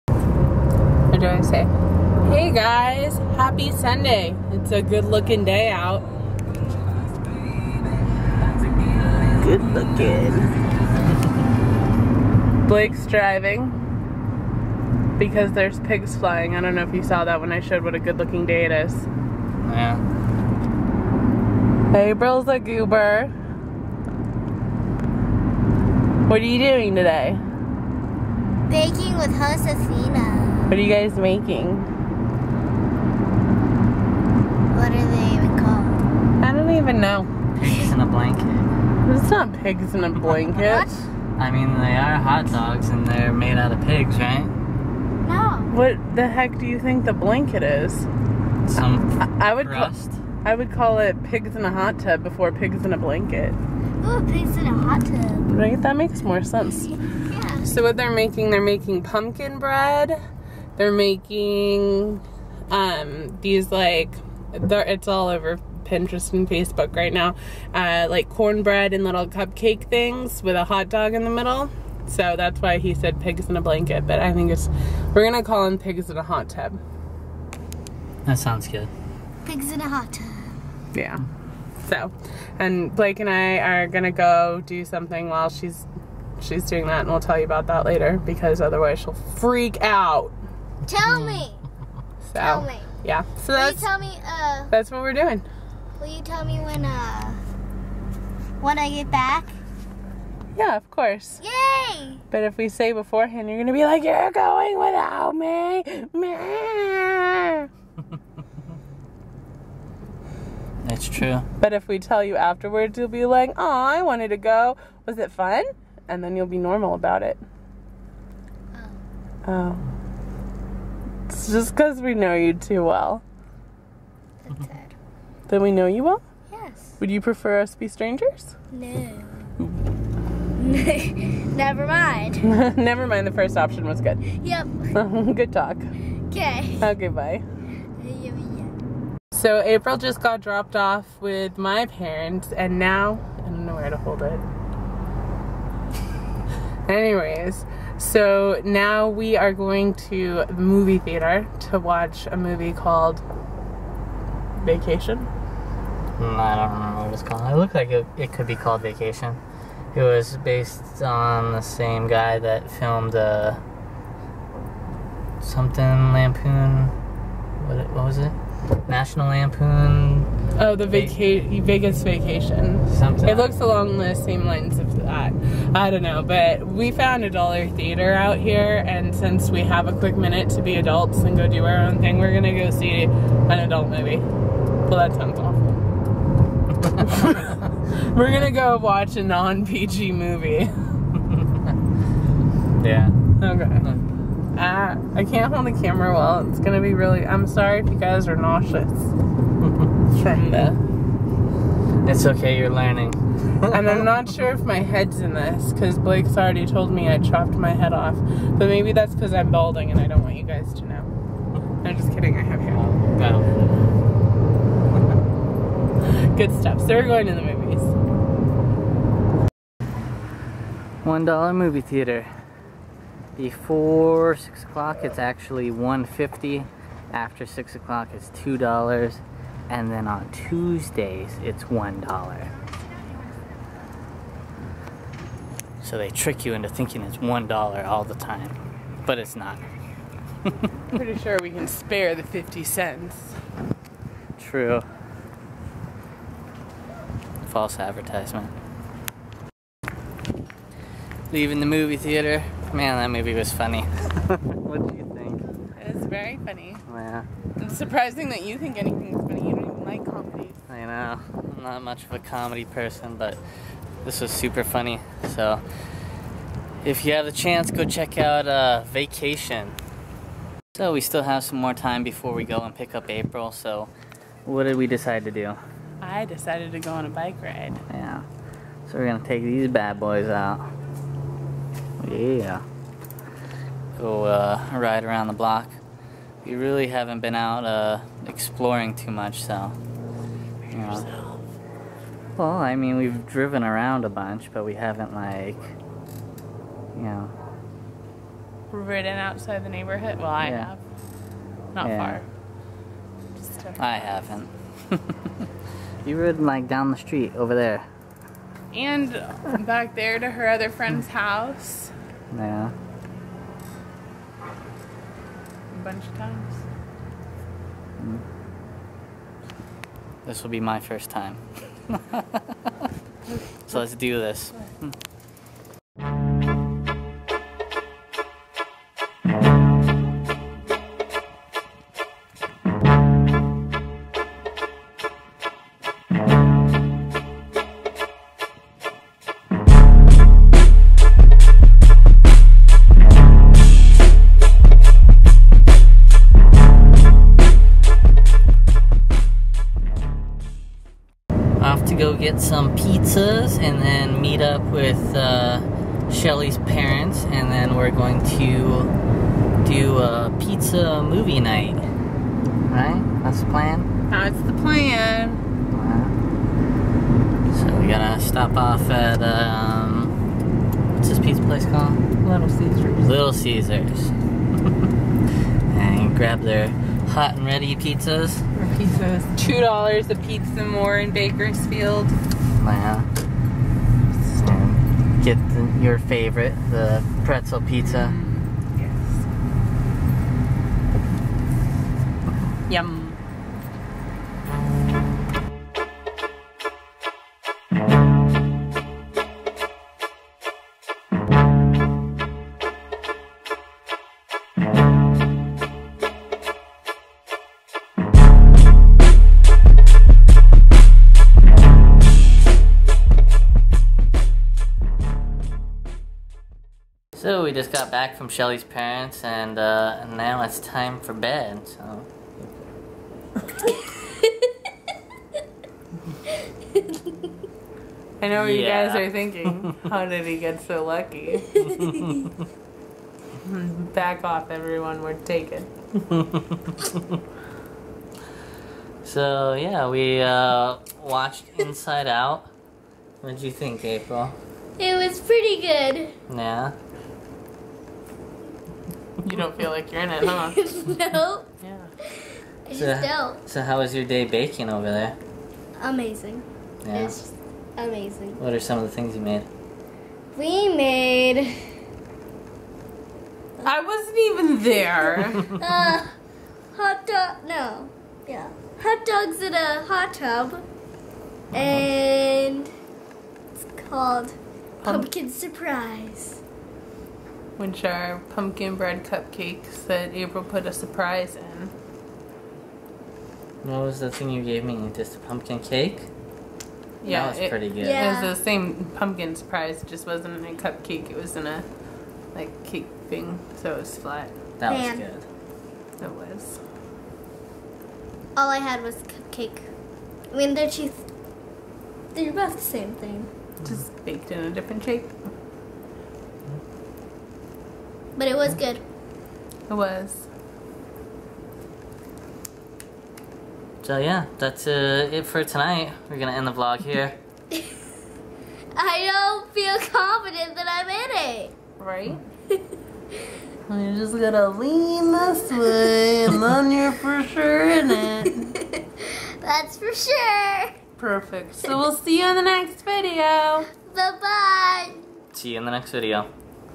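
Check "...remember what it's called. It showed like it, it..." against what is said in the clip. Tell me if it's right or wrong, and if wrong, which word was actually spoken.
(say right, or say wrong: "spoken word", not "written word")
wrong: "looked", not "showed".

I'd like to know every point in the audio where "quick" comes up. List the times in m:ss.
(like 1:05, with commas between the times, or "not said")
2:59.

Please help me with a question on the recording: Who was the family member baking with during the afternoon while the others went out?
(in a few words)
Athena.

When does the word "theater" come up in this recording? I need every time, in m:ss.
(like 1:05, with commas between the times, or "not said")
2:30, 2:57, 3:41, 4:11.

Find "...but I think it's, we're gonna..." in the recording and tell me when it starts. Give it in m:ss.
1:14.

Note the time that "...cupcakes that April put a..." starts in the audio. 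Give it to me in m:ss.
7:59.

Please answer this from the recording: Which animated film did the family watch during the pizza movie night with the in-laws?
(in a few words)
Inside Out.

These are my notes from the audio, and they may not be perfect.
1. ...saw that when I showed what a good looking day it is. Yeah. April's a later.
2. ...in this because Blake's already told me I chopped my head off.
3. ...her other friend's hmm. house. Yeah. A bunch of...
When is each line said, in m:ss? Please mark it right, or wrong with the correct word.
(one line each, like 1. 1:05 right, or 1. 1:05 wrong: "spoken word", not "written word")
1. 0:17 wrong: "goober", not "later"
2. 3:25 right
3. 5:10 right.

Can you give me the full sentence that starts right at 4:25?
So, if you have the chance, go check out uh, Vacation.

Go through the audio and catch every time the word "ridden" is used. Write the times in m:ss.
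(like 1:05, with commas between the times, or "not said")
4:58, 5:06.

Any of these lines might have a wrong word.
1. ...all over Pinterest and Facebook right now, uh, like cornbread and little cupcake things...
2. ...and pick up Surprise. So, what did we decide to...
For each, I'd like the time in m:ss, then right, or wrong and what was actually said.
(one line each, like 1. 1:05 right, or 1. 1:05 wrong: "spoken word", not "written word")
1. 1:05 right
2. 4:32 wrong: "April", not "Surprise".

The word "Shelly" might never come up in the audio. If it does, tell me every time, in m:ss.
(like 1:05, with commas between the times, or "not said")
5:56, 6:58.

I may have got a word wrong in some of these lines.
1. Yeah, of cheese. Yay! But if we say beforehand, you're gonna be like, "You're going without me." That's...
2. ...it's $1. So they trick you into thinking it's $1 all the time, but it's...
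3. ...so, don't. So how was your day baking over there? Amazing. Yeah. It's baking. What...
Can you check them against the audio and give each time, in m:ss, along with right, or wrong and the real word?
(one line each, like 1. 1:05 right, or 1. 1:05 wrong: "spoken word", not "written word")
1. 1:40 wrong: "course", not "cheese"
2. 3:51 right
3. 7:32 wrong: "amazing", not "baking".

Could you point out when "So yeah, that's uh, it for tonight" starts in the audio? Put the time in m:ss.
8:33.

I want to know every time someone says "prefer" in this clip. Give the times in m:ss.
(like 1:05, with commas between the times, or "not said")
2:07.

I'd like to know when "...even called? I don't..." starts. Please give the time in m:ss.
0:35.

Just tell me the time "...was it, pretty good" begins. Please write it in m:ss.
8:07.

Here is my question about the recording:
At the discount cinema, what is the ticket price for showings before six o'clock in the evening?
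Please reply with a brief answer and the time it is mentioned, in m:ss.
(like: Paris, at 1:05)
$1.50, at 3:45.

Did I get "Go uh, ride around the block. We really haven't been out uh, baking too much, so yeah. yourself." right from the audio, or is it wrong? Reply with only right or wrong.
wrong.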